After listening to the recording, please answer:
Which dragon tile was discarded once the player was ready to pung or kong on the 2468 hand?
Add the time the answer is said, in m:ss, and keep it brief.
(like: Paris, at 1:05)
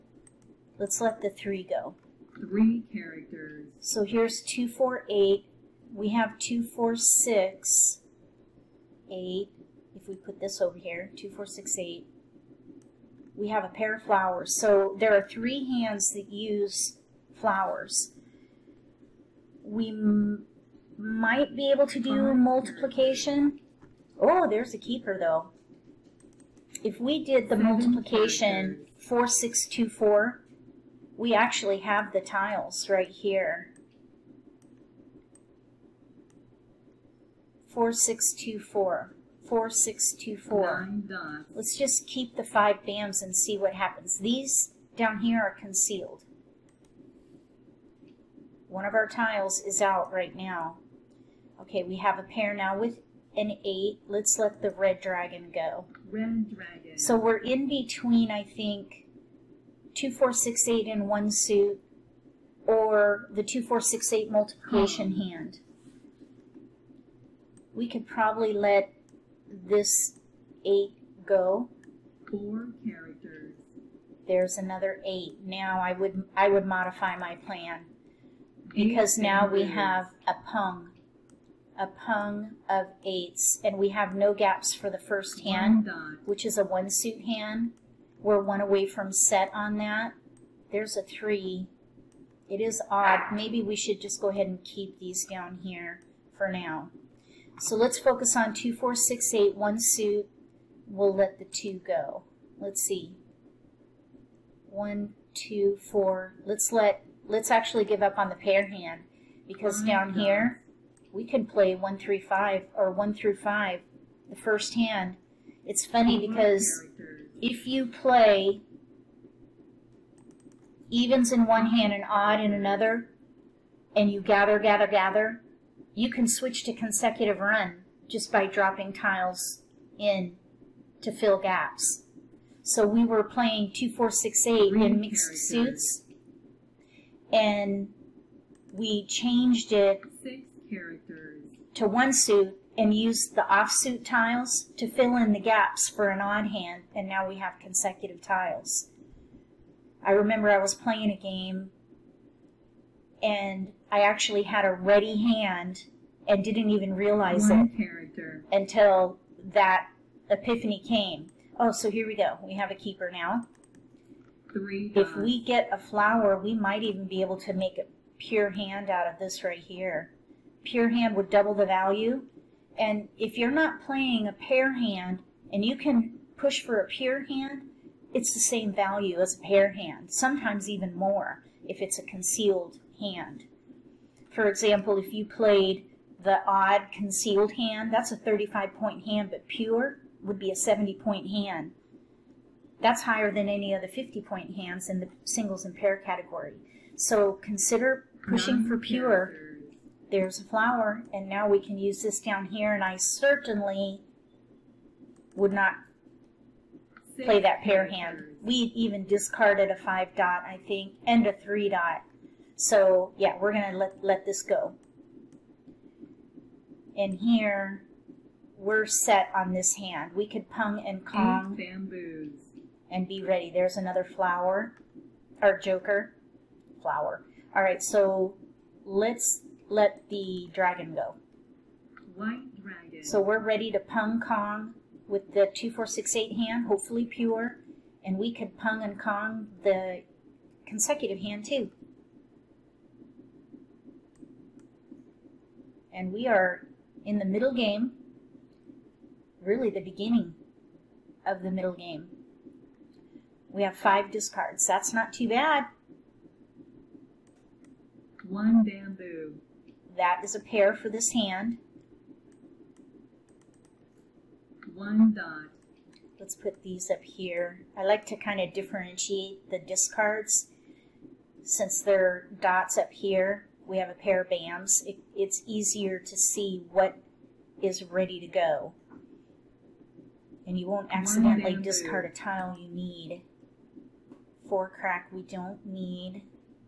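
White dragon, at 3:52.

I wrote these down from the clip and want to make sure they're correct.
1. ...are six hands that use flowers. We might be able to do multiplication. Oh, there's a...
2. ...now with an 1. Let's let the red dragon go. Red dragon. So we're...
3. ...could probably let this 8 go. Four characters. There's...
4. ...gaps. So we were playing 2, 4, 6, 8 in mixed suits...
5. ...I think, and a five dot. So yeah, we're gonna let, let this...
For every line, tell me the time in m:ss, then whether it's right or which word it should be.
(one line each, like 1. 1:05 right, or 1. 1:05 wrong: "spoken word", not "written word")
1. 0:15 wrong: "three", not "six"
2. 0:52 wrong: "8", not "1"
3. 1:07 right
4. 2:11 right
5. 3:30 wrong: "three", not "five".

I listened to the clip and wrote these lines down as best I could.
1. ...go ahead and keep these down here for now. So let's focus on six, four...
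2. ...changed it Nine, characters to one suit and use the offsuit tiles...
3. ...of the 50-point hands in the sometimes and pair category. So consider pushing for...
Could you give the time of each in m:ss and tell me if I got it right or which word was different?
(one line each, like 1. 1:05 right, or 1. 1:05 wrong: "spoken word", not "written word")
1. 1:34 wrong: "two", not "six"
2. 2:19 wrong: "Six", not "Nine"
3. 3:13 wrong: "singles", not "sometimes".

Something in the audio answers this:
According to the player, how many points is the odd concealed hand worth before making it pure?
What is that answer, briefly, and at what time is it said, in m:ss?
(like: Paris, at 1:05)
35, at 3:08.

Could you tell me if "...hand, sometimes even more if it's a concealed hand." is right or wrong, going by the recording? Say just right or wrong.
right.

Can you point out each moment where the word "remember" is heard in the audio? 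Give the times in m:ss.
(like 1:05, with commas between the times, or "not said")
2:30.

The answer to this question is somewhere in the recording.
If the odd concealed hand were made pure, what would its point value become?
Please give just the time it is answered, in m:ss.
3:10.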